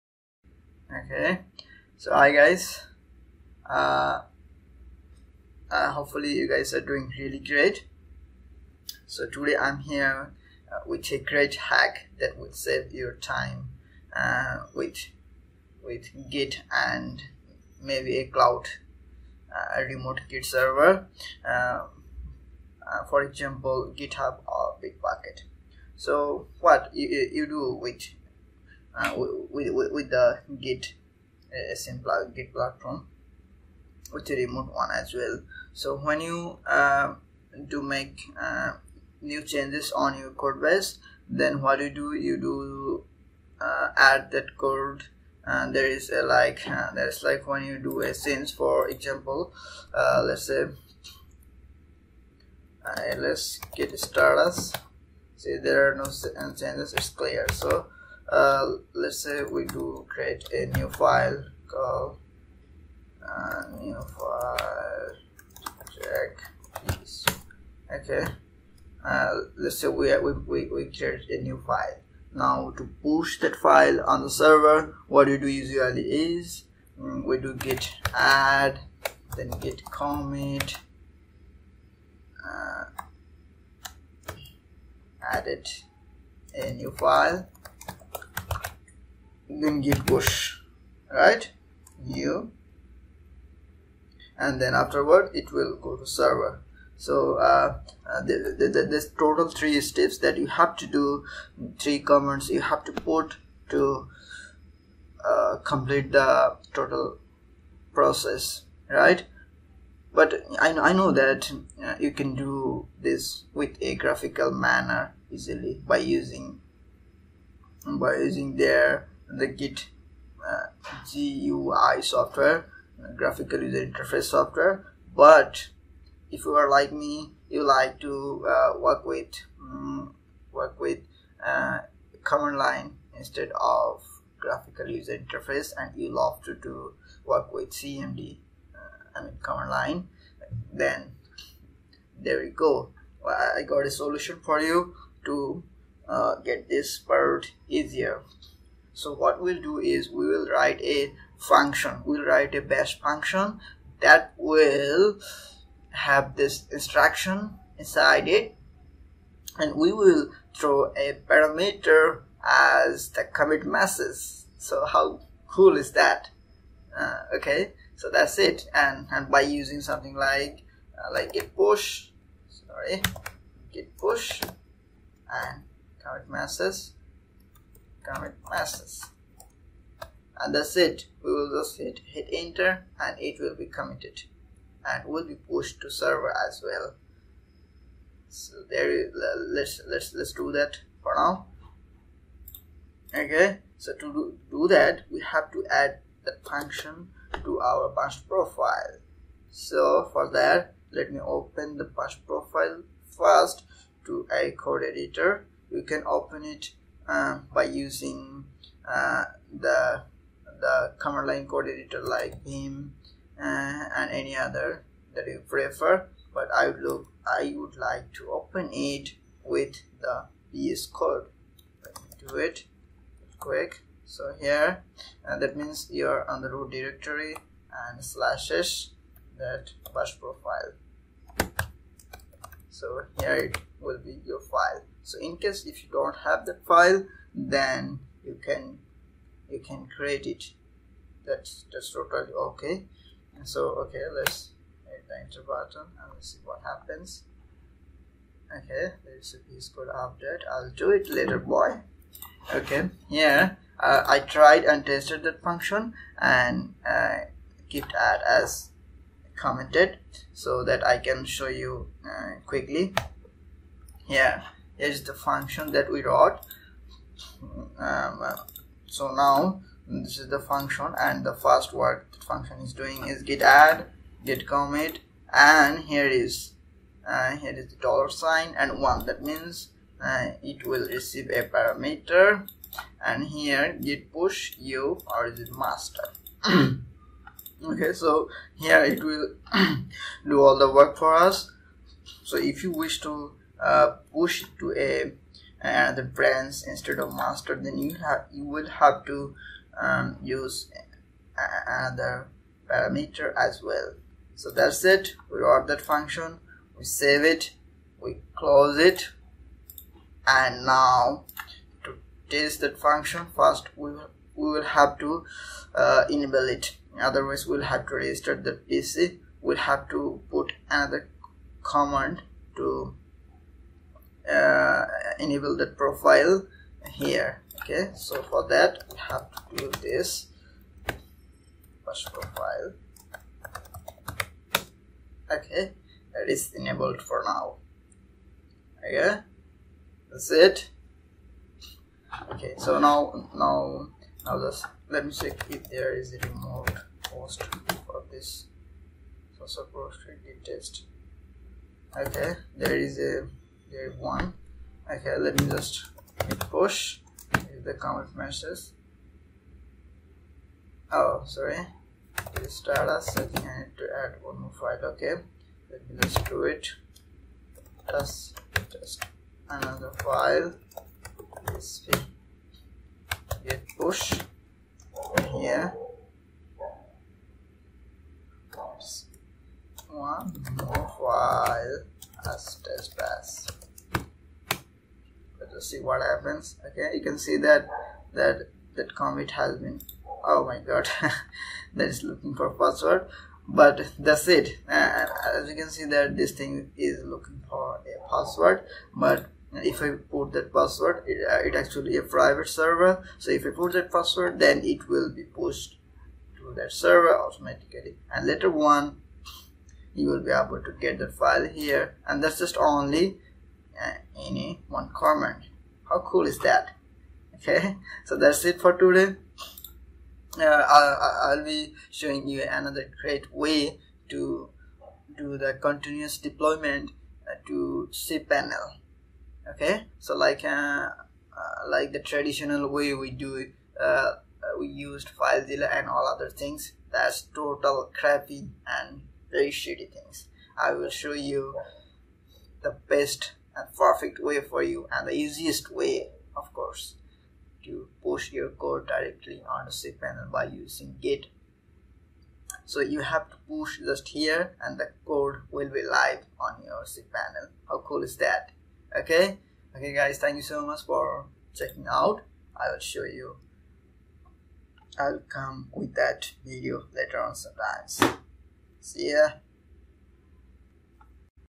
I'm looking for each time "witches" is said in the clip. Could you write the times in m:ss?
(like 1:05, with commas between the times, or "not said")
not said.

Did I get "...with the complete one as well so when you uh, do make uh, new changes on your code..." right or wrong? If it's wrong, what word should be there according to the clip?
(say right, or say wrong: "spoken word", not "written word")
wrong: "remote", not "complete".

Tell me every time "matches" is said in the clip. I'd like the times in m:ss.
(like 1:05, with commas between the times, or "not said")
5:58.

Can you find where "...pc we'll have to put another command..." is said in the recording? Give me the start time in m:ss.
5:18.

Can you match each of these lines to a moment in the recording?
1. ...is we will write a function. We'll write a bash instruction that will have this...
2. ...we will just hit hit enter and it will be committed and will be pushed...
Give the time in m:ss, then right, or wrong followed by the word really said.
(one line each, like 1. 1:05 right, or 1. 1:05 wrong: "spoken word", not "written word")
1. 2:29 wrong: "function", not "instruction"
2. 3:01 right.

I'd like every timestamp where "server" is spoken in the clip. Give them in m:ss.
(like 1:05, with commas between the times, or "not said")
0:20, 1:14, 1:36, 3:05, 6:42, 6:46.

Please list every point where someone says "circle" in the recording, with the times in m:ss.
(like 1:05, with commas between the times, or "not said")
not said.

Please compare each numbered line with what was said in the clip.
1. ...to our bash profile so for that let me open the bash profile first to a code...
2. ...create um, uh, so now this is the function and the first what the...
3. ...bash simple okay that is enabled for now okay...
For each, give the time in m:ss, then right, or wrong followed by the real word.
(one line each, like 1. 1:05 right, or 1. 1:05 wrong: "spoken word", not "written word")
1. 3:17 right
2. 4:26 wrong: "wrote", not "create"
3. 5:31 wrong: "profile", not "simple".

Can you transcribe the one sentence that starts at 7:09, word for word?
Okay, so like uh, uh, like the traditional way we do uh, uh we used FileZilla and all other things.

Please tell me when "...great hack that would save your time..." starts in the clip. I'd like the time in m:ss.
0:11.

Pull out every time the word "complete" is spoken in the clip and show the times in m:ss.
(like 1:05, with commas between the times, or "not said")
1:45.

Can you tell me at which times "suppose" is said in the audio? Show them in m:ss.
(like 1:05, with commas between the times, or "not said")
5:49.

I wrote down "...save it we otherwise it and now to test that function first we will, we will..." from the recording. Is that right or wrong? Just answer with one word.
wrong.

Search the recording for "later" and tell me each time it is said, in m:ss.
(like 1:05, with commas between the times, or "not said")
4:11, 6:48, 7:46.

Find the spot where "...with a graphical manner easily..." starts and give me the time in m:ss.
1:53.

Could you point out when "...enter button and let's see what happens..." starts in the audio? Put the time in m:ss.
4:05.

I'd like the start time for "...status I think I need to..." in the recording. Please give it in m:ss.
6:02.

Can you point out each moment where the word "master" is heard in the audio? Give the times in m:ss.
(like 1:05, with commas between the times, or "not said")
4:45, 4:57.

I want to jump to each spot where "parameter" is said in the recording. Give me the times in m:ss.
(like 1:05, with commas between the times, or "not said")
2:41, 4:41, 5:02.